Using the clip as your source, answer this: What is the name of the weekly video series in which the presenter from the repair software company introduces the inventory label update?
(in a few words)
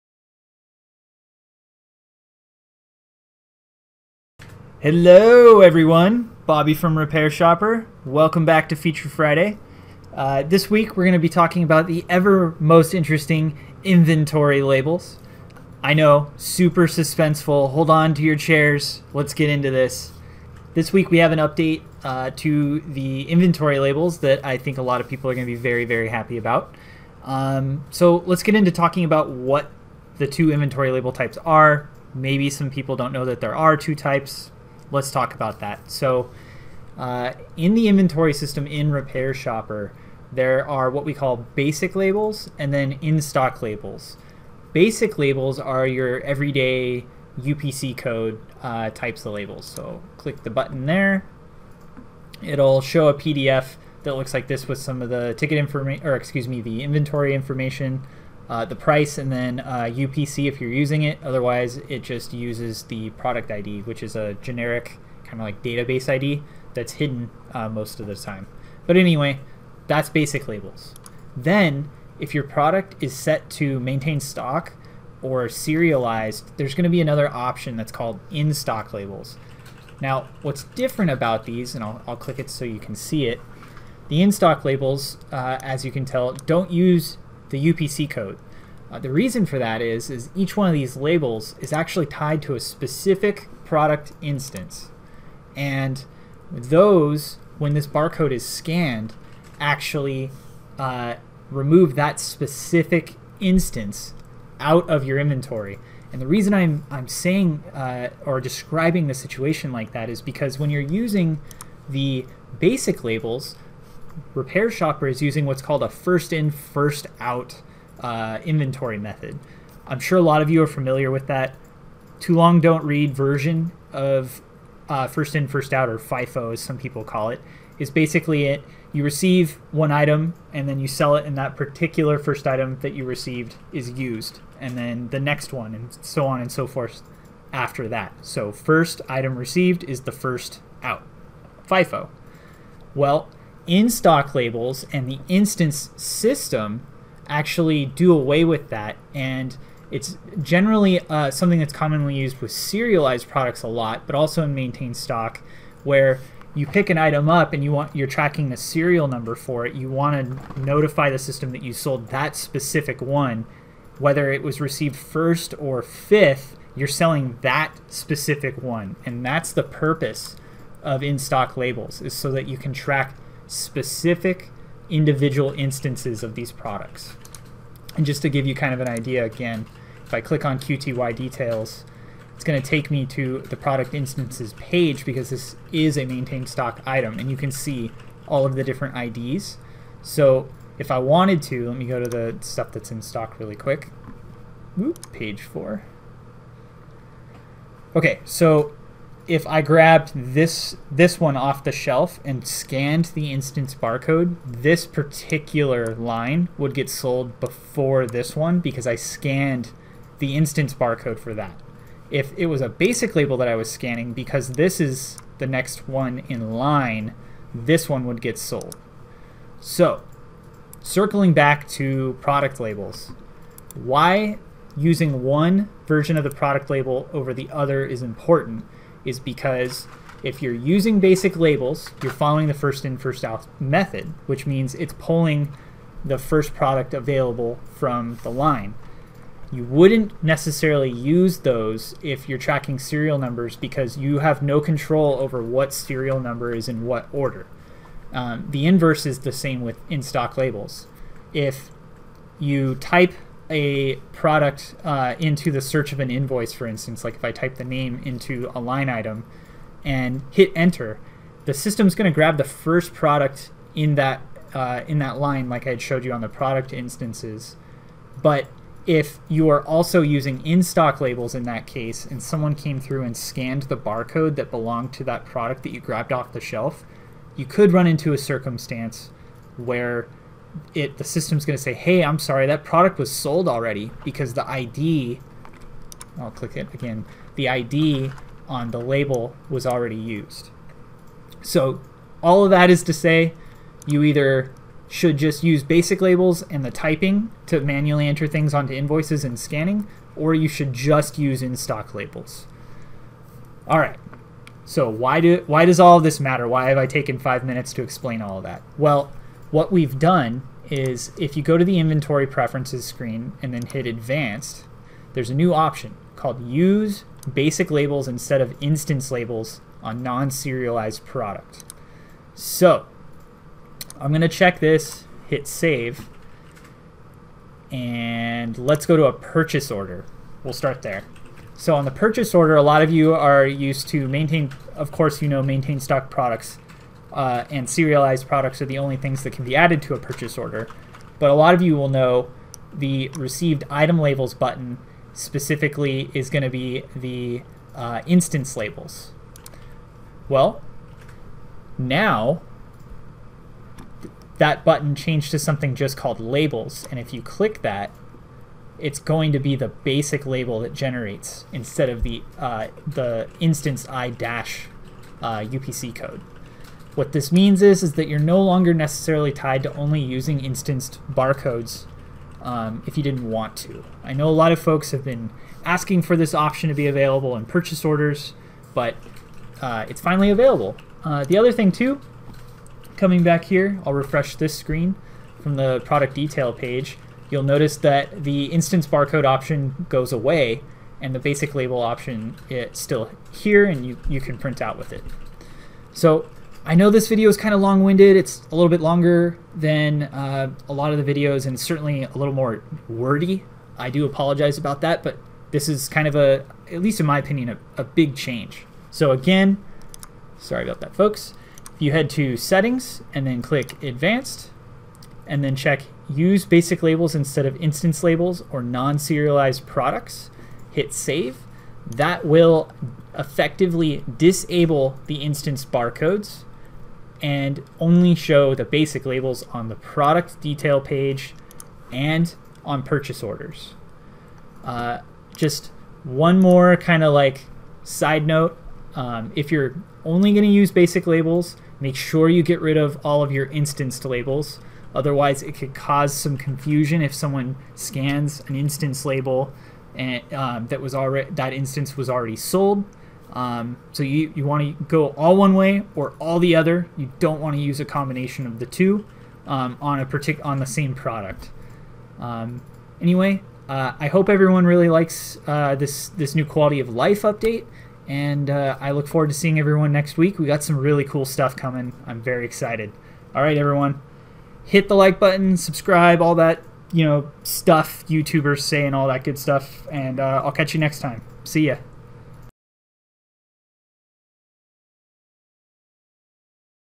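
Feature Friday.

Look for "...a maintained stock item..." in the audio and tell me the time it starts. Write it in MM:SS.
03:05.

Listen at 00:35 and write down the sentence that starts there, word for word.
So, uh, in the inventory system in RepairShopr, there are what we call basic labels and then in stock labels.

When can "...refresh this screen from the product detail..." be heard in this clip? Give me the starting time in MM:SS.
06:23.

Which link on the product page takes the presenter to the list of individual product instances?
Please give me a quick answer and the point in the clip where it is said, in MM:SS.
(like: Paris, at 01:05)
QTY details, at 03:00.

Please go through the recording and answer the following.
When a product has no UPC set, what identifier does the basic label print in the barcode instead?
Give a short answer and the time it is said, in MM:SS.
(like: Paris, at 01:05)
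product ID, at 01:03.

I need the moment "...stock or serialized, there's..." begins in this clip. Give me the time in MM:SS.
01:14.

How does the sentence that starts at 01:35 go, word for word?
And those, when this barcode is scanned, actually uh, remove that specific instance out of your inventory.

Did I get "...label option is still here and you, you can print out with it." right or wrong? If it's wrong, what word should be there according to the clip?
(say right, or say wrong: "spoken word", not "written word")
right.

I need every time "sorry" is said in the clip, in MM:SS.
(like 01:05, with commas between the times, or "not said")
04:42, 06:50.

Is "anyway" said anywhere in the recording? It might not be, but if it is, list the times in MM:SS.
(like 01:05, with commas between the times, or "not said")
01:08, 07:42.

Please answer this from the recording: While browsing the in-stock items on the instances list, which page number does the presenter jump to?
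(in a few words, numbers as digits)
page four.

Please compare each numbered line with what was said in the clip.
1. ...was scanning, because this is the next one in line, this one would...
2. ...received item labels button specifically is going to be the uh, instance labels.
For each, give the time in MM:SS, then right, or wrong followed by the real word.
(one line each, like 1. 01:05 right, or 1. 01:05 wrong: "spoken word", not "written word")
1. 03:33 right
2. 05:43 right.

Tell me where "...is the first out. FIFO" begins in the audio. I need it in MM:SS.
02:19.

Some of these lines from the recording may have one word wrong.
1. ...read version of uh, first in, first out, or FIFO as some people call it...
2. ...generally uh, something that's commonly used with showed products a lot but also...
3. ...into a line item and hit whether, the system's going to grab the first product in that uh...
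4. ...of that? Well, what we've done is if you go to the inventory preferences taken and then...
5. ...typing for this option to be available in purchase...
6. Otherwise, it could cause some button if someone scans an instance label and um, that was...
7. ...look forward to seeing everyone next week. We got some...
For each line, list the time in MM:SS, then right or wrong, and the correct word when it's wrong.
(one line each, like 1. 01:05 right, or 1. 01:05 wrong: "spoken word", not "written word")
1. 02:02 right
2. 02:30 wrong: "serialized", not "showed"
3. 04:18 wrong: "enter", not "whether"
4. 05:08 wrong: "screen", not "taken"
5. 06:15 wrong: "asking", not "typing"
6. 07:24 wrong: "confusion", not "button"
7. 07:48 right.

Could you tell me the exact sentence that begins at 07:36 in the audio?
You don't want to use a combination of the two um, on a partic- on the same product.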